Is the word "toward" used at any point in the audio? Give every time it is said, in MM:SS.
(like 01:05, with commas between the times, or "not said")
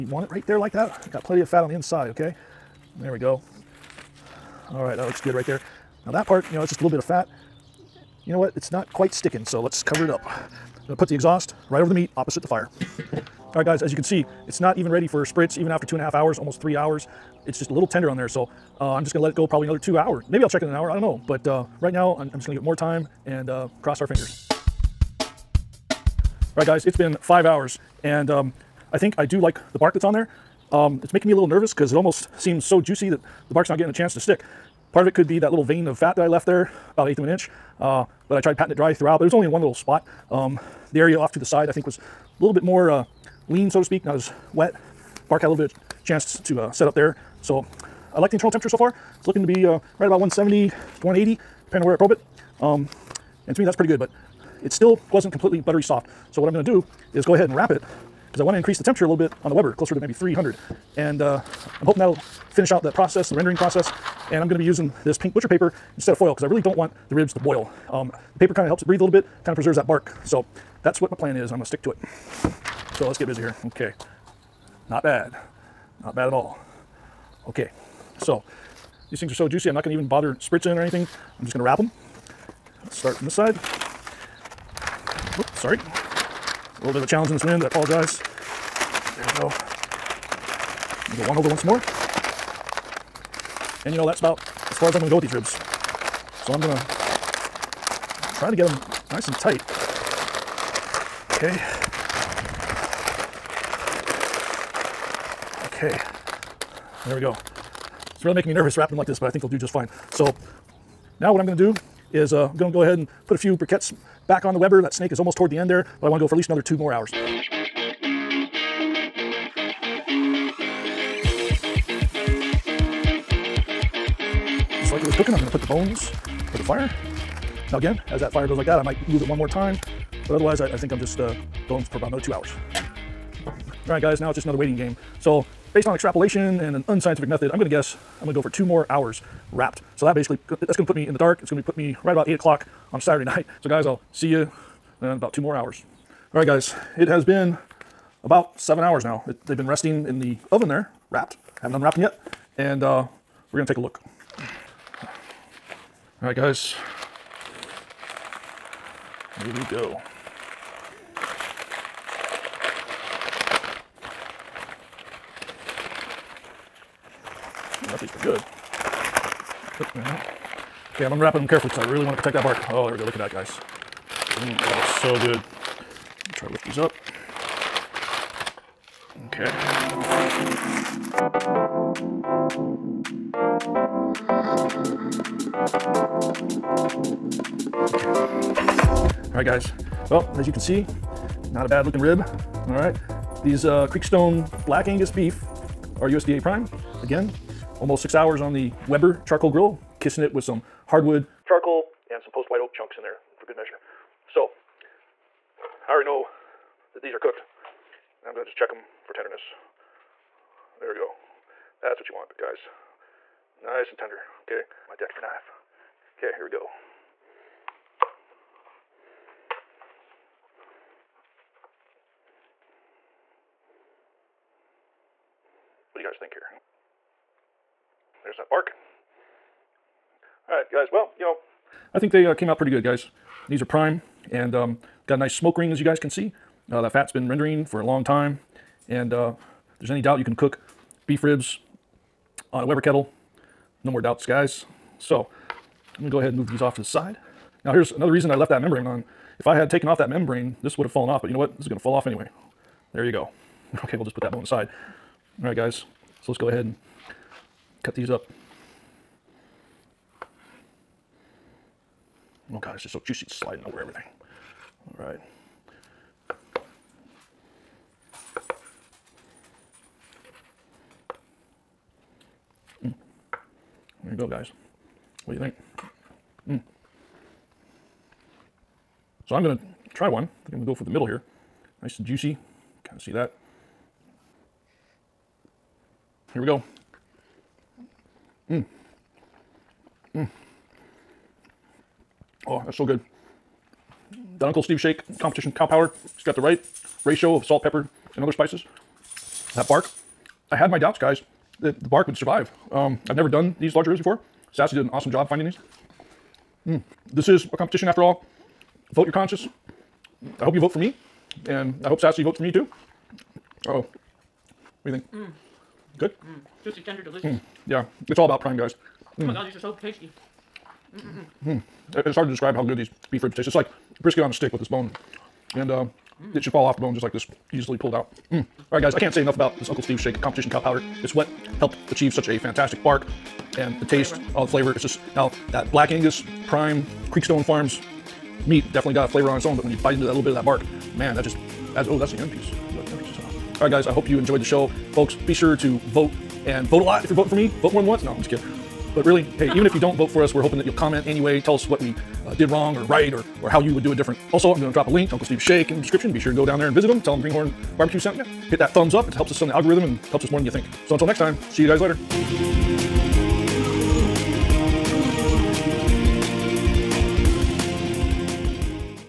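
01:55.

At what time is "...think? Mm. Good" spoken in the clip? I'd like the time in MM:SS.
05:14.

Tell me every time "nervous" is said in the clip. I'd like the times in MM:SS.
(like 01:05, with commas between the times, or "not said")
00:31, 01:48.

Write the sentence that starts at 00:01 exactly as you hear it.
Got plenty of fat on the inside, okay?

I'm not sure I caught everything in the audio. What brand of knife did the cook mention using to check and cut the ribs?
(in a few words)
Dexter.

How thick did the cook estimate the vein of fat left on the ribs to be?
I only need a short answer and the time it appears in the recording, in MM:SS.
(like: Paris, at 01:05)
an eighth of an inch, at 00:37.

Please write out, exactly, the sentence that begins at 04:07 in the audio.
Now here's another reason I left that membrane on.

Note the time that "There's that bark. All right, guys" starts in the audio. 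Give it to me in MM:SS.
03:48.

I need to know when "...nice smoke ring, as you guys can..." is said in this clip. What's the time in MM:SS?
03:55.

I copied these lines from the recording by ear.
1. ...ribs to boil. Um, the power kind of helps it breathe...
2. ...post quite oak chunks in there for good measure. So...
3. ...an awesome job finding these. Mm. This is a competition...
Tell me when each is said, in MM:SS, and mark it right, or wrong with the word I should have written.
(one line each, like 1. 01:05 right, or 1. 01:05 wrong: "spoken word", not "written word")
1. 01:07 wrong: "paper", not "power"
2. 03:22 wrong: "white", not "quite"
3. 05:04 right.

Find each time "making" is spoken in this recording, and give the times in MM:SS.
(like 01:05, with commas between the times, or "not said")
00:31, 01:48.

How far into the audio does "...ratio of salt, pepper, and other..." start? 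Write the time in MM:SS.
04:57.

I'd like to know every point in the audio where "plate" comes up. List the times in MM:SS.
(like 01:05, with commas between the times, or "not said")
not said.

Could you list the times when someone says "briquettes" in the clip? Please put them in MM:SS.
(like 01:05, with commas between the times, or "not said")
01:53.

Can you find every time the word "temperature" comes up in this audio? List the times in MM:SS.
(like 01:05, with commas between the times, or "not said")
00:48, 00:58.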